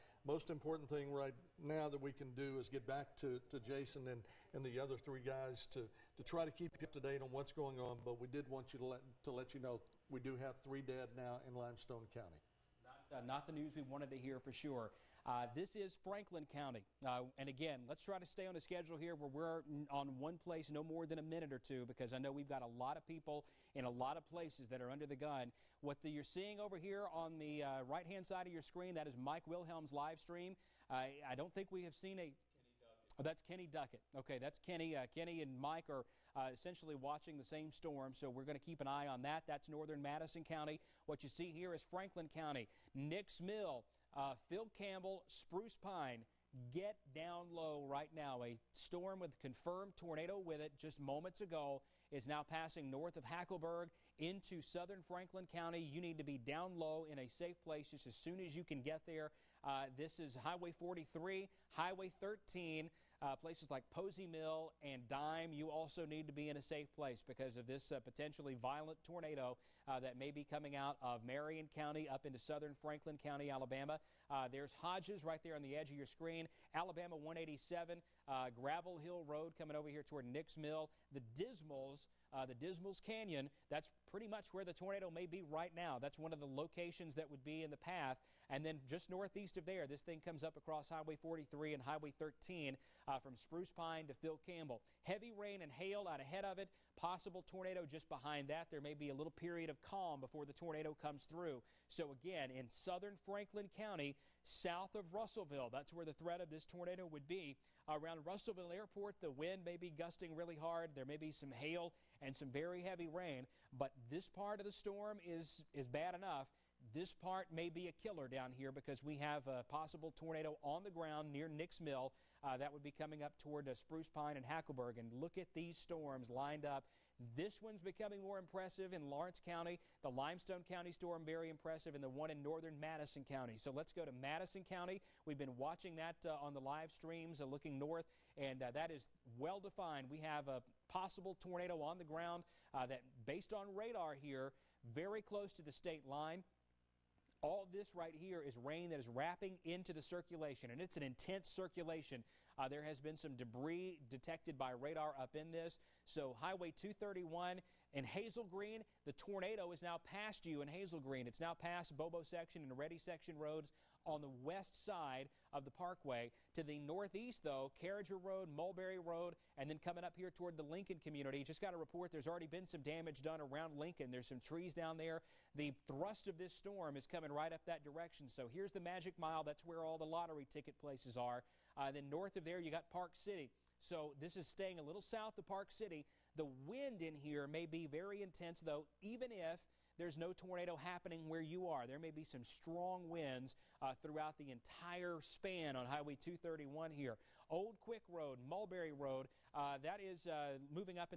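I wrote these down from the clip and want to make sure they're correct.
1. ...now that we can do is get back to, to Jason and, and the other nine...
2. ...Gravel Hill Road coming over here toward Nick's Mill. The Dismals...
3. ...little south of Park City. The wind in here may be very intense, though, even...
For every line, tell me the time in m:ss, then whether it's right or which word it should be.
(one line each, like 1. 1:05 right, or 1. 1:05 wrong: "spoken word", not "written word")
1. 0:01 wrong: "three", not "nine"
2. 1:18 right
3. 3:04 right.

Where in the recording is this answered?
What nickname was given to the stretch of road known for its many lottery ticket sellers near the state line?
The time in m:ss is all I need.
2:58.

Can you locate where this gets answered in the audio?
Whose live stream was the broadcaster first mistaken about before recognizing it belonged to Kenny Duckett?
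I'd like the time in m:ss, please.
0:29.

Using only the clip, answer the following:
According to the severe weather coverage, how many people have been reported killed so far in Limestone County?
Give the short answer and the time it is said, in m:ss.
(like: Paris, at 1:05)
3, at 0:10.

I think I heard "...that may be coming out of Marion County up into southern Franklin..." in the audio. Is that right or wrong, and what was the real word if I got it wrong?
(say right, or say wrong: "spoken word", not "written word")
right.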